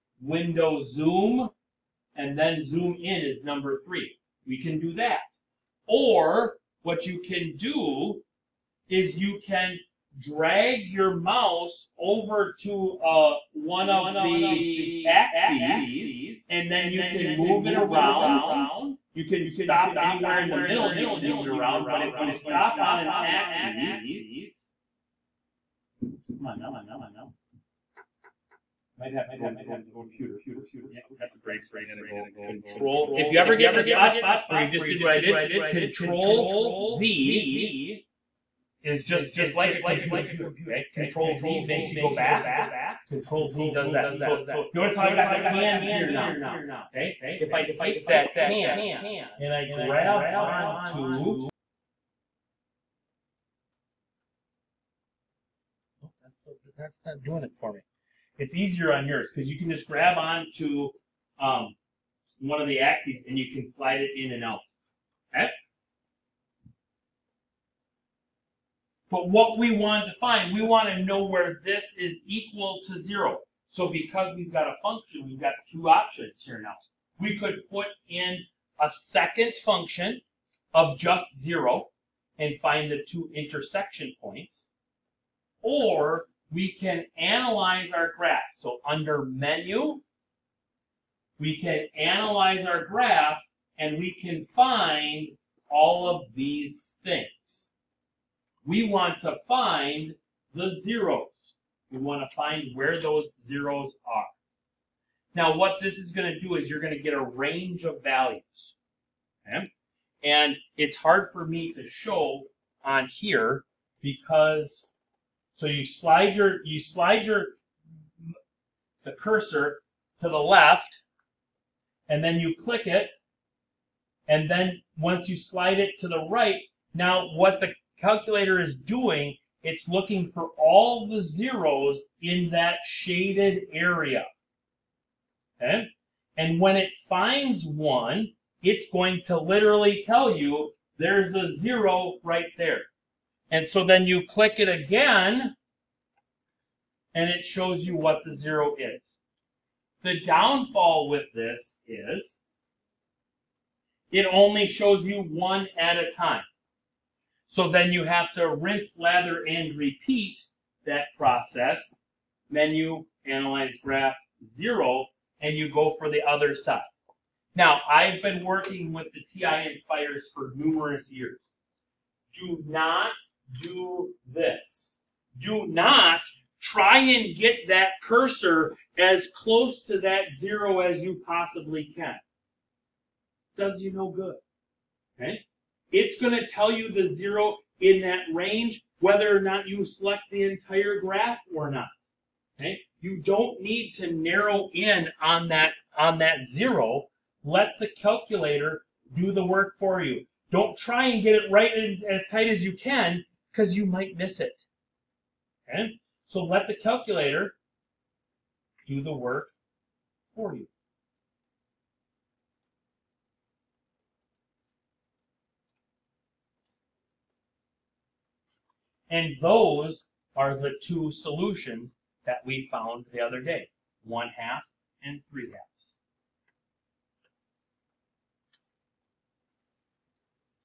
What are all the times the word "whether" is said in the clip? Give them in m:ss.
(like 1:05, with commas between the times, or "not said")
3:08.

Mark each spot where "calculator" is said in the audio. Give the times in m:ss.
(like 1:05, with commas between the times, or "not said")
2:08, 3:17, 3:26.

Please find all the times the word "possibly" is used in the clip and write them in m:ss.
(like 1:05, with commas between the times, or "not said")
3:01.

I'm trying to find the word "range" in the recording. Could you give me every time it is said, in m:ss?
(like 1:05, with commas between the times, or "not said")
1:47, 3:08.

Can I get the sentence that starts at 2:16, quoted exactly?
And when it finds one, it's going to literally tell you there's a zero right there.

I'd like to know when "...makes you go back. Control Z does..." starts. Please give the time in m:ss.
0:41.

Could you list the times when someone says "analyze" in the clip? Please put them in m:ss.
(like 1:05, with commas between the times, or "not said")
1:27, 1:31, 2:43.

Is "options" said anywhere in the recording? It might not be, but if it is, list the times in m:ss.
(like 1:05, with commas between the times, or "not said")
1:15.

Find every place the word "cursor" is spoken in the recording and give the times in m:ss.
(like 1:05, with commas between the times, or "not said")
1:59, 2:58.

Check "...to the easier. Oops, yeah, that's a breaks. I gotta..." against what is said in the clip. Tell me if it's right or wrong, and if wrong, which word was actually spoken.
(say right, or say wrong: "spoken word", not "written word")
wrong: "computer", not "easier".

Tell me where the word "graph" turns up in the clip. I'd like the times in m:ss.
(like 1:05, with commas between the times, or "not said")
1:28, 1:32, 2:43, 3:11.